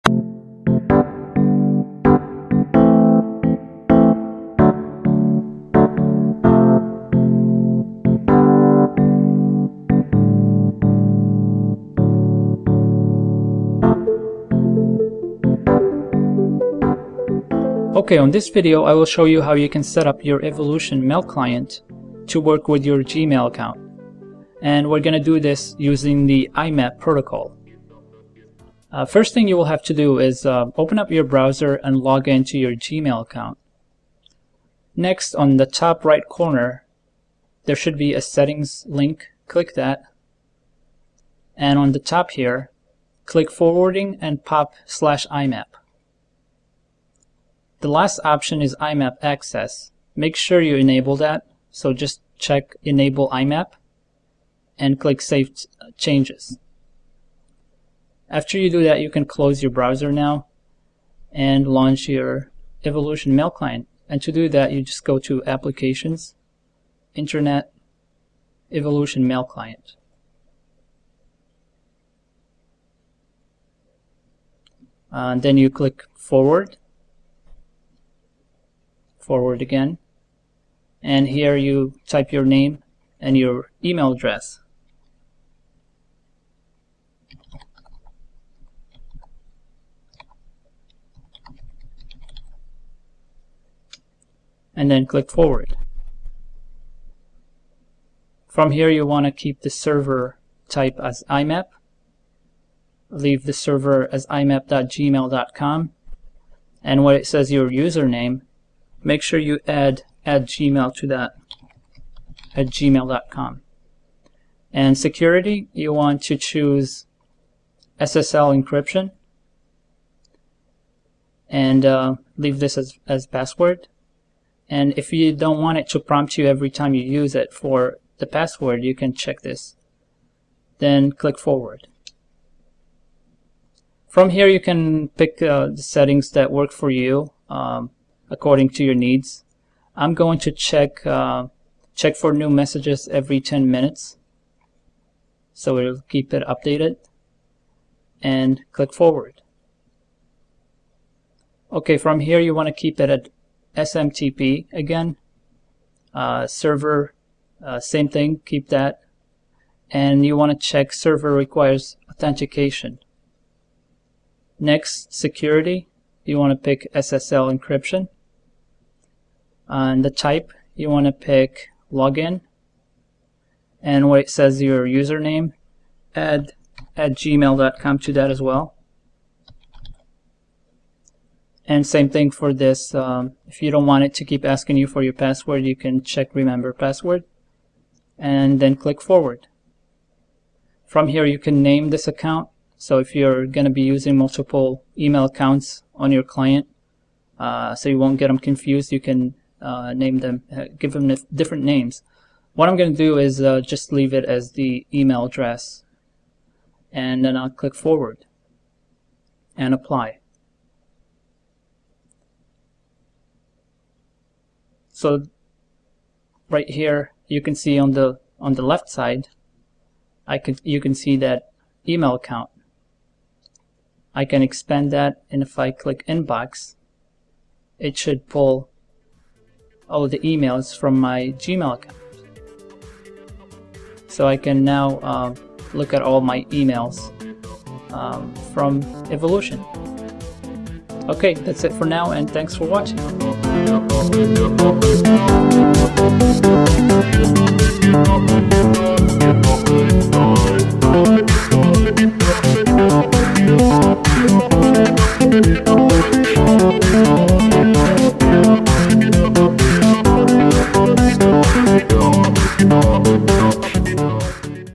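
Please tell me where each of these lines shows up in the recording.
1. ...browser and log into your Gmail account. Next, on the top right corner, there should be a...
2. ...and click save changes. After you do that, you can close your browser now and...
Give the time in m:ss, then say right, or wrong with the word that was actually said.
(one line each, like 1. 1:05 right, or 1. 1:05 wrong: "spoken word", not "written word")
1. 0:31 right
2. 0:54 right.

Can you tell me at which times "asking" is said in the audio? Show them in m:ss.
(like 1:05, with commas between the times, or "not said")
3:04.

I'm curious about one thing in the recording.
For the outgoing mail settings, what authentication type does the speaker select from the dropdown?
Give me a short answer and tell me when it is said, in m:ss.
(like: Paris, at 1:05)
Login, at 2:51.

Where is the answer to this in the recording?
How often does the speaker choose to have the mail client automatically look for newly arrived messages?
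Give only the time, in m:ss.
2:23.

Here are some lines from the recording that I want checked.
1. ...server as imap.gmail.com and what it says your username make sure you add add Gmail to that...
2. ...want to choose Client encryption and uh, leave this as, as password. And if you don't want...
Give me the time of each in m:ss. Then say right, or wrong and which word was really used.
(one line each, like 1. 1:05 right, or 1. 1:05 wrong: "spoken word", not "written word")
1. 1:43 right
2. 1:55 wrong: "SSL", not "Client".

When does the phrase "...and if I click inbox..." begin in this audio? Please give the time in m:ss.
3:45.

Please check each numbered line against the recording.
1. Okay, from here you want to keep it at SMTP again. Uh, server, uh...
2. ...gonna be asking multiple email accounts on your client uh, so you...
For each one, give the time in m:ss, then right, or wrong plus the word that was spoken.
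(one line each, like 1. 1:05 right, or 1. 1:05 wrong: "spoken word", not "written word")
1. 2:31 right
2. 3:13 wrong: "using", not "asking".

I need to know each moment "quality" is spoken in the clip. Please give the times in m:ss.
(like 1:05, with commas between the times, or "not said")
not said.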